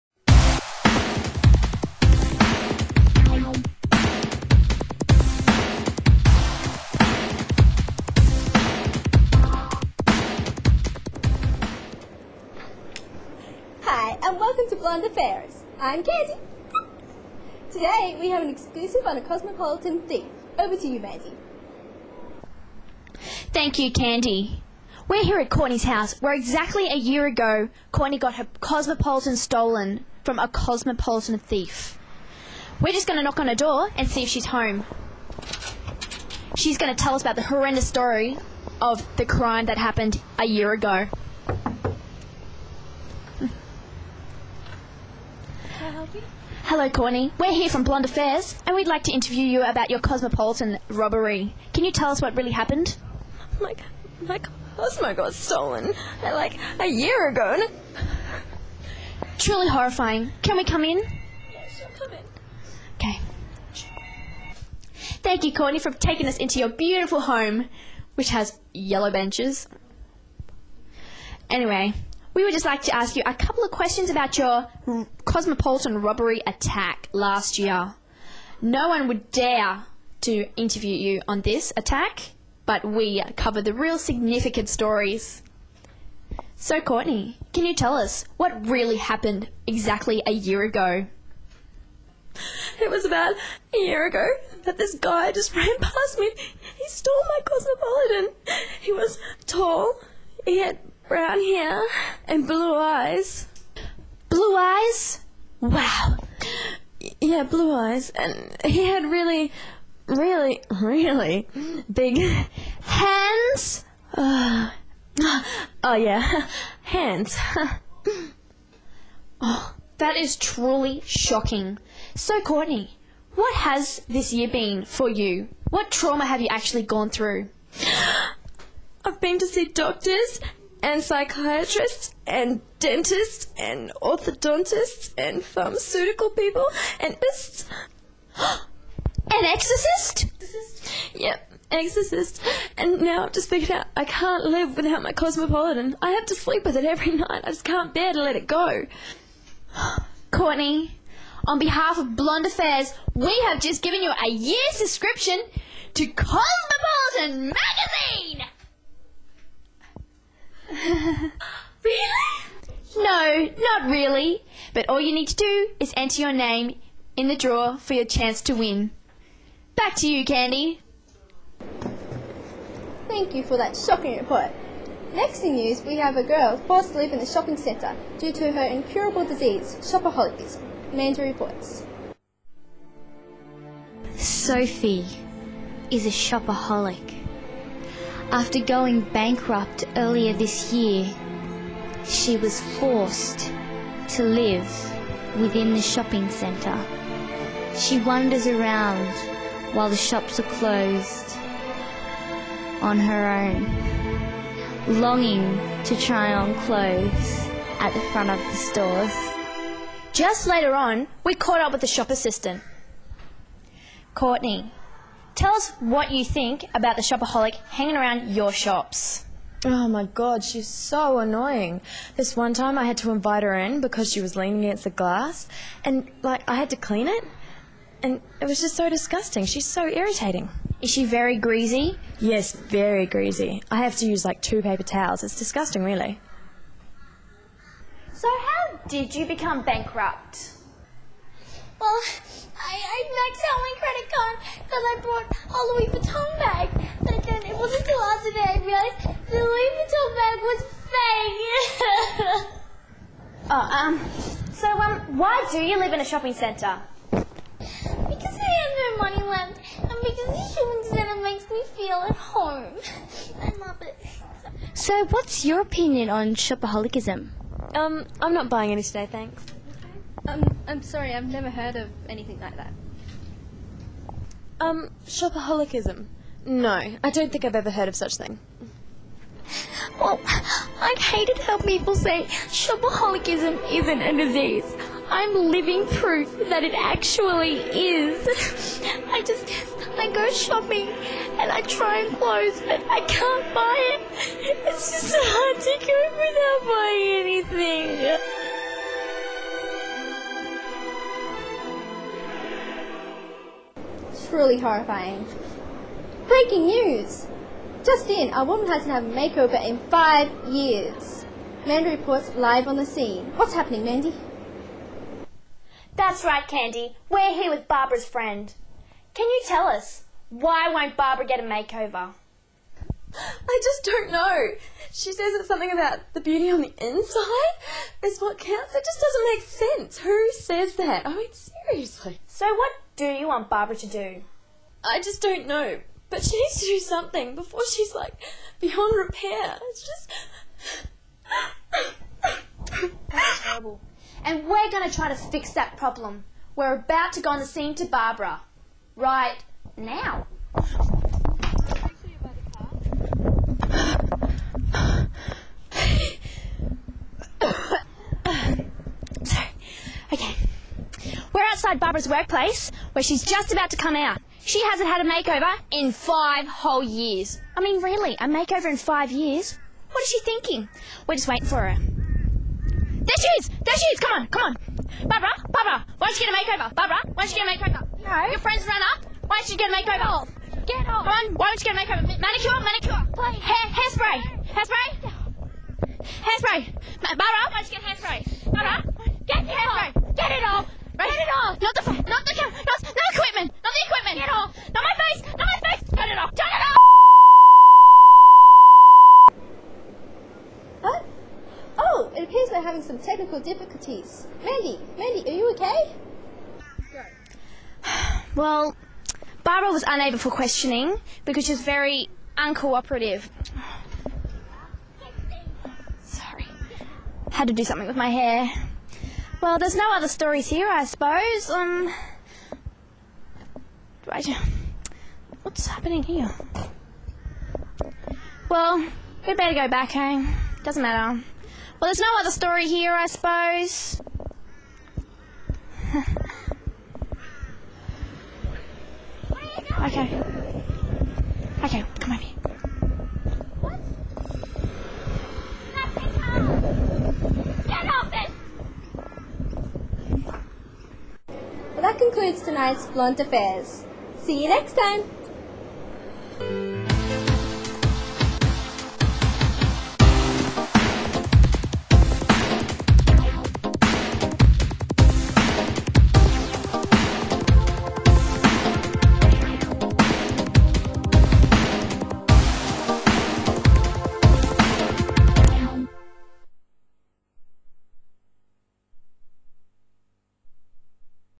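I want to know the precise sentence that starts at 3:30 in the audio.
Just later on, we caught up with the shop assistant.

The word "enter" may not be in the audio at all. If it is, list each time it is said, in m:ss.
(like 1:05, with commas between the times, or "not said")
2:45.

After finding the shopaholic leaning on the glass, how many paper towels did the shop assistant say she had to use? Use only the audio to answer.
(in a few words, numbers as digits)
2.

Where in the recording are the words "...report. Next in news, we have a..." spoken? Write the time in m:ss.
2:54.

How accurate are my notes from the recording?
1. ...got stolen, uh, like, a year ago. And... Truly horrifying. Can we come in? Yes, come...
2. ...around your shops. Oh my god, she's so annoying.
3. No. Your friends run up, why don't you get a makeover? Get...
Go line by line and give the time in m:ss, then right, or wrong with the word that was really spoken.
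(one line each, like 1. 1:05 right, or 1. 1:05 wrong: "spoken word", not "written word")
1. 0:55 right
2. 3:37 right
3. 6:18 right.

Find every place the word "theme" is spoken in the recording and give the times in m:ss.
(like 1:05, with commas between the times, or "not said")
0:20.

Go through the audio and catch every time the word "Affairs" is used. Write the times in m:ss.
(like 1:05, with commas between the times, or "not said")
0:48, 2:32, 7:33.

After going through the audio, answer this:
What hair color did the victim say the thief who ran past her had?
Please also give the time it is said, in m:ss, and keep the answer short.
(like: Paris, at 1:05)
Brown, at 1:41.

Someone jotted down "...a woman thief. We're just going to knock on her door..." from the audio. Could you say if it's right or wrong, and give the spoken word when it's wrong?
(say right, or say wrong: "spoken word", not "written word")
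wrong: "cosmopolitan", not "woman".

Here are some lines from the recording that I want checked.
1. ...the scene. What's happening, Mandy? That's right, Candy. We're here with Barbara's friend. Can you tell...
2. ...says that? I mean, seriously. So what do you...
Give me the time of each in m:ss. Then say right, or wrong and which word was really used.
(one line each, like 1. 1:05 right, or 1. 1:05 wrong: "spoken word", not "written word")
1. 5:12 right
2. 5:30 right.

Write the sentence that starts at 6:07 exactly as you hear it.
I mean, really, a makeover in five years?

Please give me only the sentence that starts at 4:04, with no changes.
I brought a Louis Vuitton bag.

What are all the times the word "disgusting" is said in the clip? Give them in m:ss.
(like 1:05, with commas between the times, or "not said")
3:48, 3:55.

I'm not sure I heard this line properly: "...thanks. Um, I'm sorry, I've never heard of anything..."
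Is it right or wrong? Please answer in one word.
right.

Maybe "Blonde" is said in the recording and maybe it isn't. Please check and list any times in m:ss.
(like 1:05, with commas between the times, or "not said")
0:47, 2:32, 7:32.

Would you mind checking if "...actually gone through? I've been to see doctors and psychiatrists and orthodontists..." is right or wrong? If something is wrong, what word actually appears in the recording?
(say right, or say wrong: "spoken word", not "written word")
wrong: "dentists", not "orthodontists".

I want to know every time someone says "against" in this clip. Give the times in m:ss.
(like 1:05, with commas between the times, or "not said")
3:44.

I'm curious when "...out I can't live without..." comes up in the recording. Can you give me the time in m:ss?
2:23.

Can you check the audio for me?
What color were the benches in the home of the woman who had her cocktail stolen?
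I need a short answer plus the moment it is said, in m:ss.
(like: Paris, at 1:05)
Yellow, at 1:08.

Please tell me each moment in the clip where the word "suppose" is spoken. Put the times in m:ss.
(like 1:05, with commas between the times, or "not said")
7:00, 7:13.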